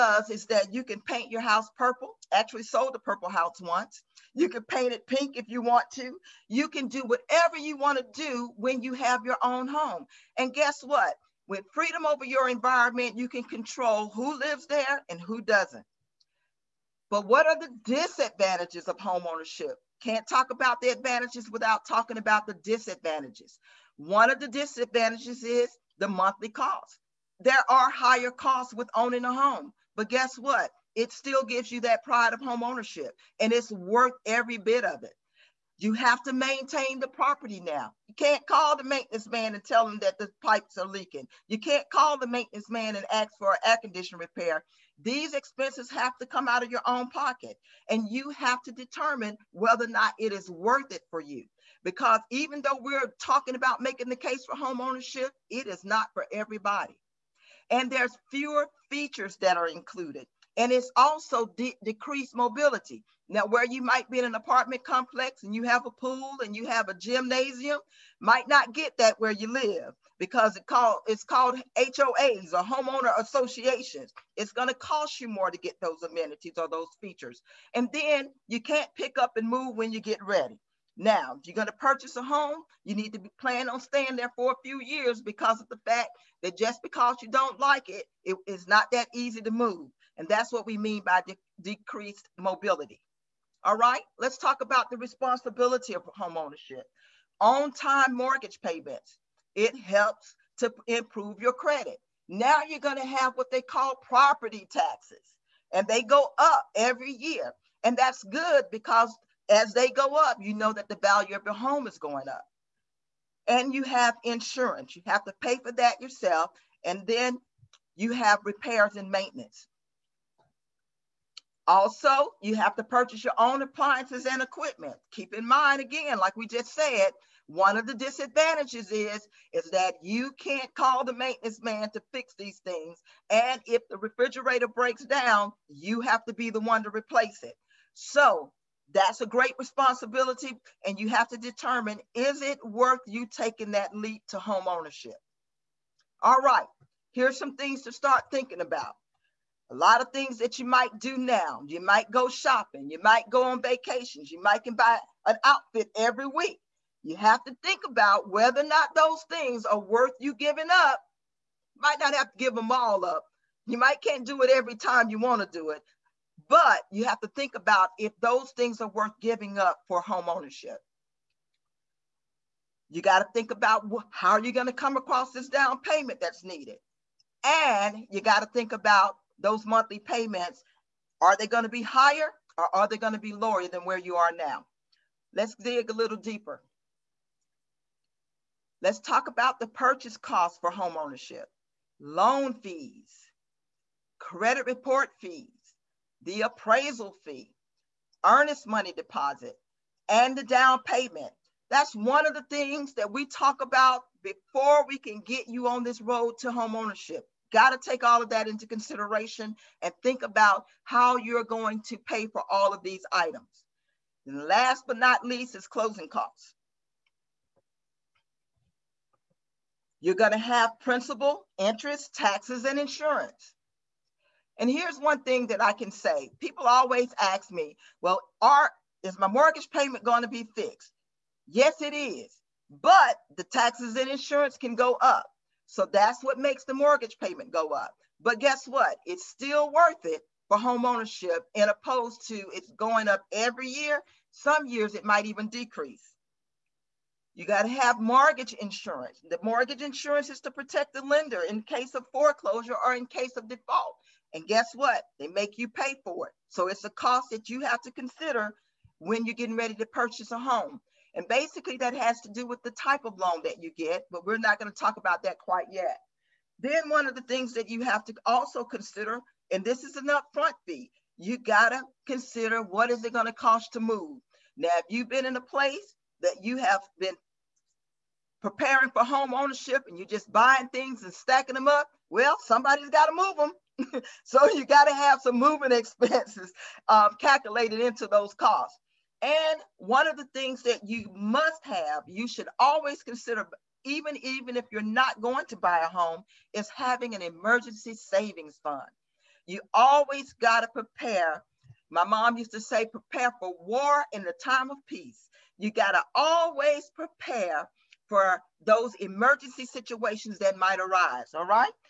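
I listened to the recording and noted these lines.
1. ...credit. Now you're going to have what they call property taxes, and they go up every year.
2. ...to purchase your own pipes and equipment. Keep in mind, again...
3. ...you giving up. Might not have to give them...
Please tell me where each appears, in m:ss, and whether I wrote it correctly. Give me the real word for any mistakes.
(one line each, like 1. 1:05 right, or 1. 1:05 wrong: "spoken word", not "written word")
1. 1:41 right
2. 2:02 wrong: "appliances", not "pipes"
3. 2:40 right.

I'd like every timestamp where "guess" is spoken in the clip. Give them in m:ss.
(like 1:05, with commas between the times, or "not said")
0:10, 0:30, 3:58, 4:14.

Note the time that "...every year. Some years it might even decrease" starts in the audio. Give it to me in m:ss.
4:03.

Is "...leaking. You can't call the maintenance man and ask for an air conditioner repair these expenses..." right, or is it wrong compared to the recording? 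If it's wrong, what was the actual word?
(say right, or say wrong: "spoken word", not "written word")
right.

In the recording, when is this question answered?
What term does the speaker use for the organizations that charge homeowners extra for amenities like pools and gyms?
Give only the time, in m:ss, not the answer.
1:12.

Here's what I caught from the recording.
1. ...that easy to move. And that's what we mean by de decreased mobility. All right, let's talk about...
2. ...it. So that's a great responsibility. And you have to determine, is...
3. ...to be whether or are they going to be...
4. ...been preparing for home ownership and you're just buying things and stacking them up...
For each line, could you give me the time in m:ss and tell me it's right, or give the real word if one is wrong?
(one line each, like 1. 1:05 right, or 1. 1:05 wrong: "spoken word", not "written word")
1. 1:28 right
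2. 2:17 right
3. 3:01 wrong: "higher", not "whether"
4. 4:36 right.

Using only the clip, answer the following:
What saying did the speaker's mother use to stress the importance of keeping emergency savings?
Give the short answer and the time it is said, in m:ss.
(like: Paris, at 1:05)
prepare for war in the time of peace, at 5:02.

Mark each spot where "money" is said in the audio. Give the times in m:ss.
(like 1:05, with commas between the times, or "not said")
3:18.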